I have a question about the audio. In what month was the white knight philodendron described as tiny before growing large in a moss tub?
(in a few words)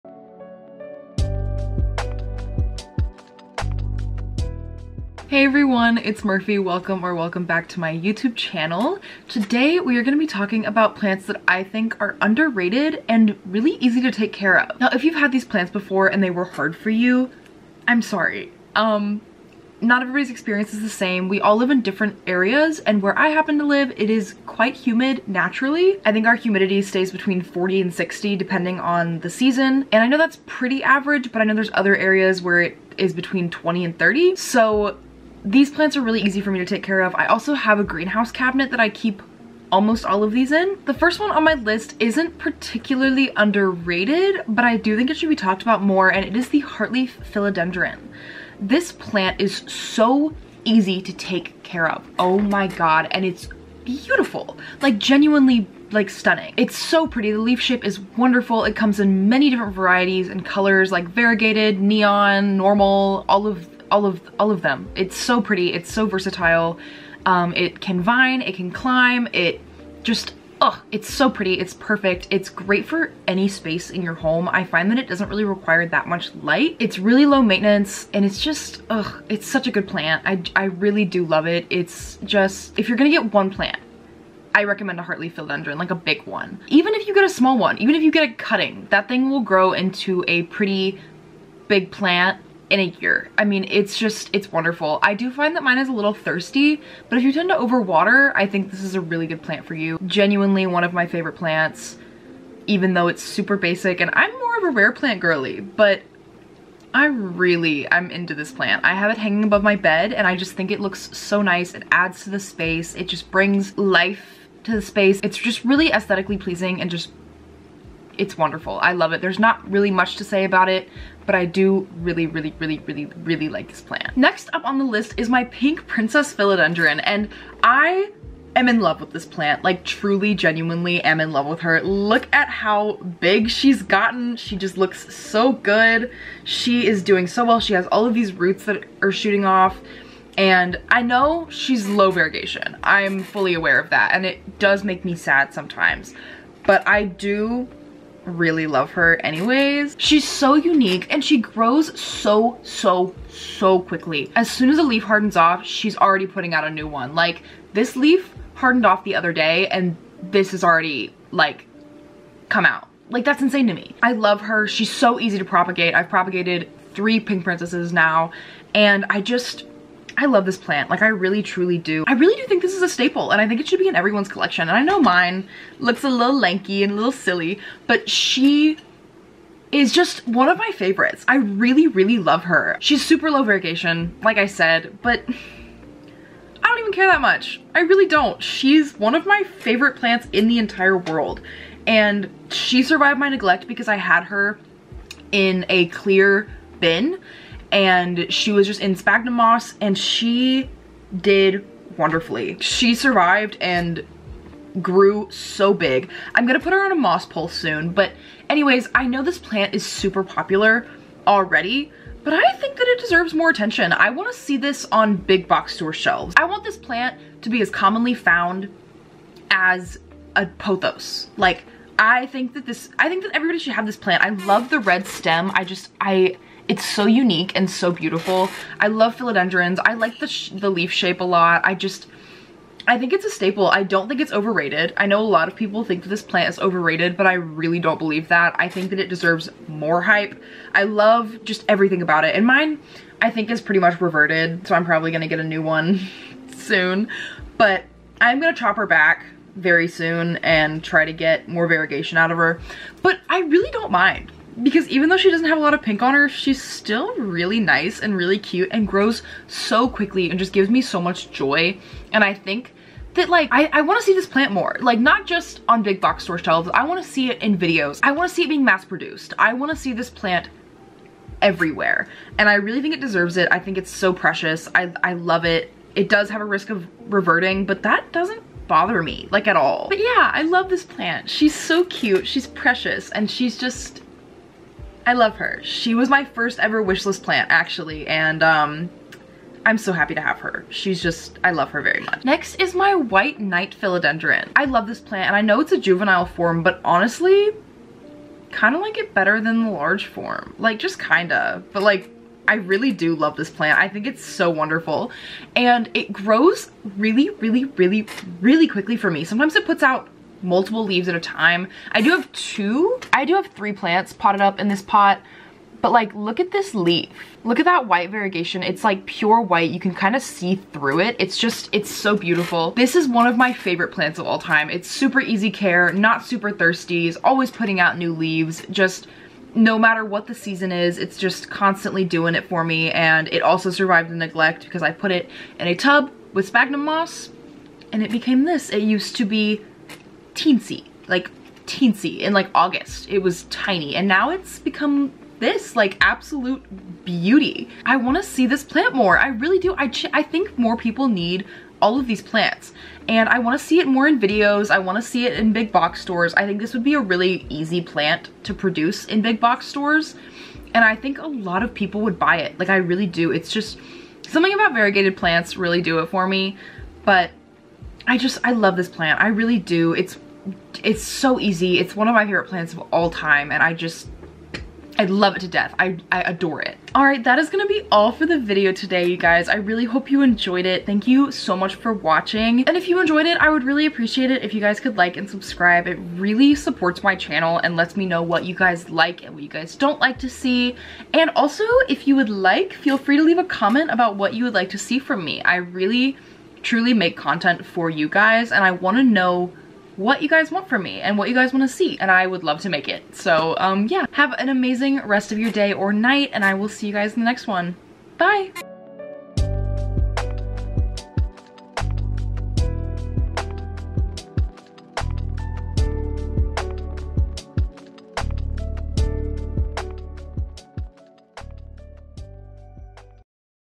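August.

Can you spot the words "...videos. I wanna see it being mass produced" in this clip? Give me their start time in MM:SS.
04:27.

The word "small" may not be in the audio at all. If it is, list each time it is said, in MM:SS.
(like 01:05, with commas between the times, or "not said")
01:27.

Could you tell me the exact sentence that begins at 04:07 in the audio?
But I'm gonna chop her back very soon and try to get more variegation out of her.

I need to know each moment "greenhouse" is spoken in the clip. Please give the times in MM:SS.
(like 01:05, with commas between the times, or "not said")
00:37.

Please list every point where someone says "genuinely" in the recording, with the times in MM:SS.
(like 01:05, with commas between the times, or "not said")
00:54, 01:40, 02:10.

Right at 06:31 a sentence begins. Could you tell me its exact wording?
And also, if you would like, feel free to leave a comment about what you would like to see from me.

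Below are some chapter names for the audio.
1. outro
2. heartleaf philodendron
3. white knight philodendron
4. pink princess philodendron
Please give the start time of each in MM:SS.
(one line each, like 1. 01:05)
1. 06:17
2. 00:40
3. 04:52
4. 02:04.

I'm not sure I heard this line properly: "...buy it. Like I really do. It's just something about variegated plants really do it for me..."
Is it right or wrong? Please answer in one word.
right.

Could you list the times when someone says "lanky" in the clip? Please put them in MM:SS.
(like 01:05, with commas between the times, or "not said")
02:56.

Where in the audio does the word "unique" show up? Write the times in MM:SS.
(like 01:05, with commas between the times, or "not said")
02:30, 03:47.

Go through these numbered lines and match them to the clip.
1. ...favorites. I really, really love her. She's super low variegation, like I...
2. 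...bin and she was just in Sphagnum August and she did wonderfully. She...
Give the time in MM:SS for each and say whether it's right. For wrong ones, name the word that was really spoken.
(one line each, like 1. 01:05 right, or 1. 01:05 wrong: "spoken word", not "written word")
1. 03:00 right
2. 03:16 wrong: "Moss", not "August".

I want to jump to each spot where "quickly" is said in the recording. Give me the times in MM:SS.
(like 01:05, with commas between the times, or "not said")
02:33, 04:19, 05:08.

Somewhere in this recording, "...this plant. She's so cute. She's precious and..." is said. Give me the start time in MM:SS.
04:40.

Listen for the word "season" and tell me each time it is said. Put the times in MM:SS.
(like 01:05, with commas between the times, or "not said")
00:29, 05:30.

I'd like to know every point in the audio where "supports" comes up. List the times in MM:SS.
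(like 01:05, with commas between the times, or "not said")
06:26.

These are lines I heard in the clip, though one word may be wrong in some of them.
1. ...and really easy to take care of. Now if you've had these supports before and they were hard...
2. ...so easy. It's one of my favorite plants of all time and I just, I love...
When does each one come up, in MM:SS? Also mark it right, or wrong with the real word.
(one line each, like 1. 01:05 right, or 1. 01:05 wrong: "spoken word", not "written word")
1. 00:13 wrong: "plants", not "supports"
2. 06:11 right.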